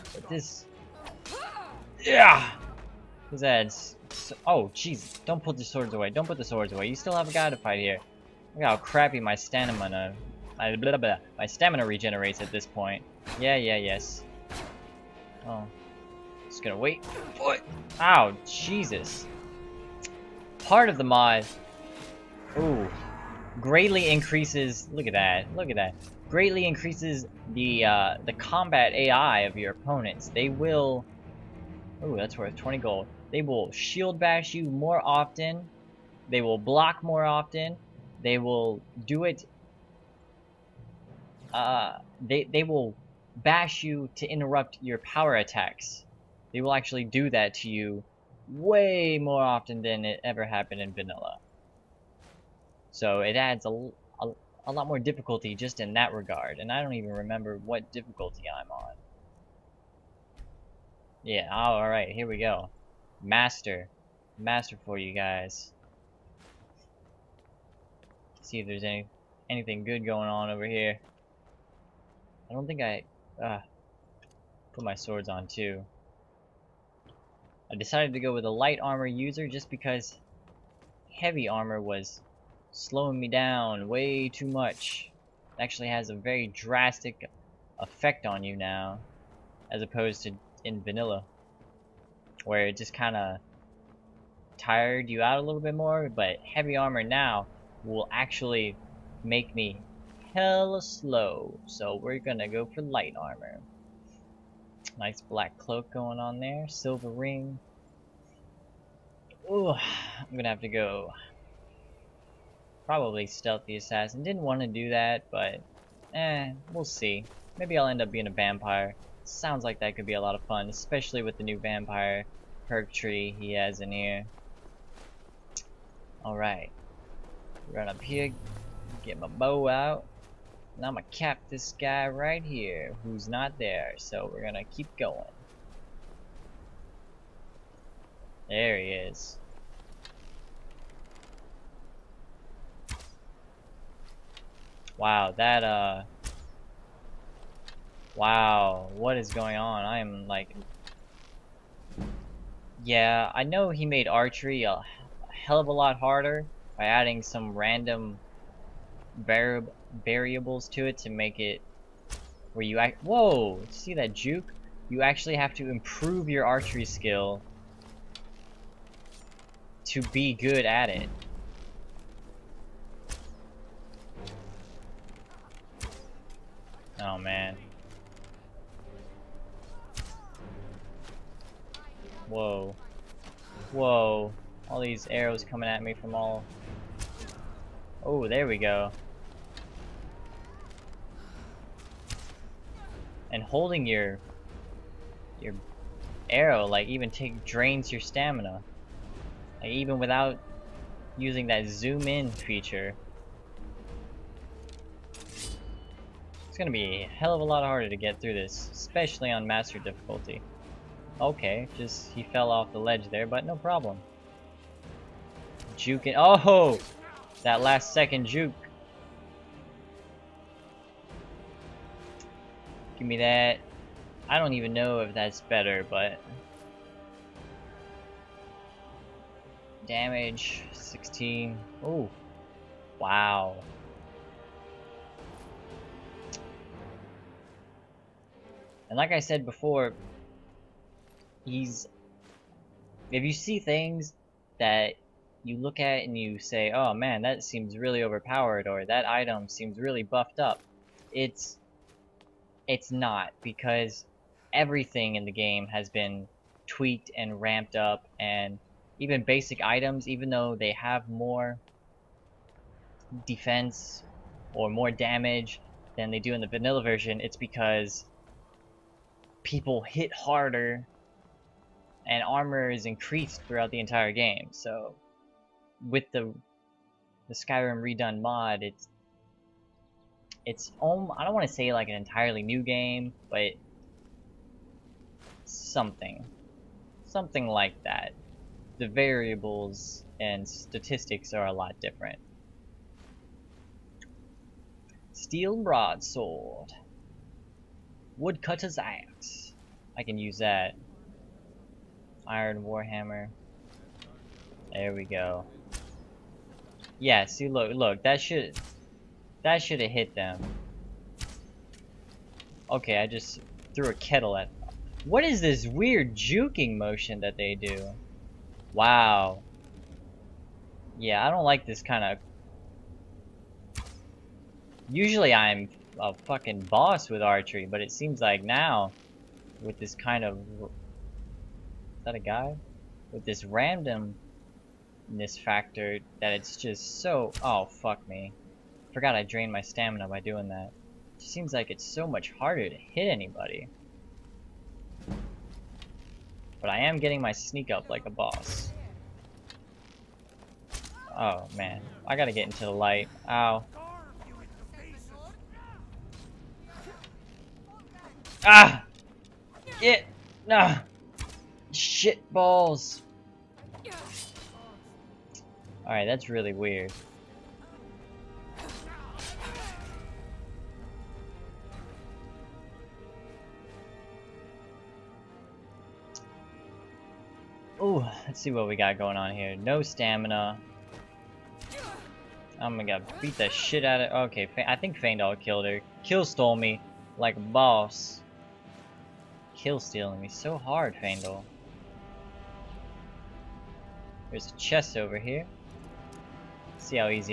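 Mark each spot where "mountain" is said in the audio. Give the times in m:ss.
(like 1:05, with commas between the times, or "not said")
not said.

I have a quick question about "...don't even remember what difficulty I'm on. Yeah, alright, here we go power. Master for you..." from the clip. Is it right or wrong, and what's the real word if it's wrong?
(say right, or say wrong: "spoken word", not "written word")
wrong: "master", not "power".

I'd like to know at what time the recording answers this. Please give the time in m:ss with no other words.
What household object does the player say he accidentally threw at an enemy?
5:13.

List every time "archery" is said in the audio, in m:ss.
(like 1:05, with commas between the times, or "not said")
2:34, 2:46, 5:27.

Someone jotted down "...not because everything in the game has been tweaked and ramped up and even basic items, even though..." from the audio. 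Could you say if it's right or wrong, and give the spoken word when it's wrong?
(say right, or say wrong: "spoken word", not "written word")
right.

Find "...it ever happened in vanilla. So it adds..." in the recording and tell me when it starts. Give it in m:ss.
0:50.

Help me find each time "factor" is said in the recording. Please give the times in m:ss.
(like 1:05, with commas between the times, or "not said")
5:35.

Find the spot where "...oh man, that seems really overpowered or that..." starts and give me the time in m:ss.
4:06.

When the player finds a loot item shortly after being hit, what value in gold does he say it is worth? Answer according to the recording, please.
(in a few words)
20.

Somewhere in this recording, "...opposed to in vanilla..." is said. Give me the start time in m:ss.
1:29.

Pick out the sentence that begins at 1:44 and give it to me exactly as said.
Nice black cloak going on there, silver ring.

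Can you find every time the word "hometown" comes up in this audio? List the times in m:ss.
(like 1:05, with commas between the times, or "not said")
not said.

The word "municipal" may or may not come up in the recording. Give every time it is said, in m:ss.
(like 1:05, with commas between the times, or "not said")
not said.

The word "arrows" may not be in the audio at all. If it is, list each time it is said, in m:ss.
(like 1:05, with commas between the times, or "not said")
3:05, 3:16.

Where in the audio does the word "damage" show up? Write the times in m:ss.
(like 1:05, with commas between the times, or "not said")
3:49, 4:24.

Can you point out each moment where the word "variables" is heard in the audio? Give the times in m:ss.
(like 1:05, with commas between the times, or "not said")
2:40, 4:48.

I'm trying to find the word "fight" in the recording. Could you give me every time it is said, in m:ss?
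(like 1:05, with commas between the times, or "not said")
0:07.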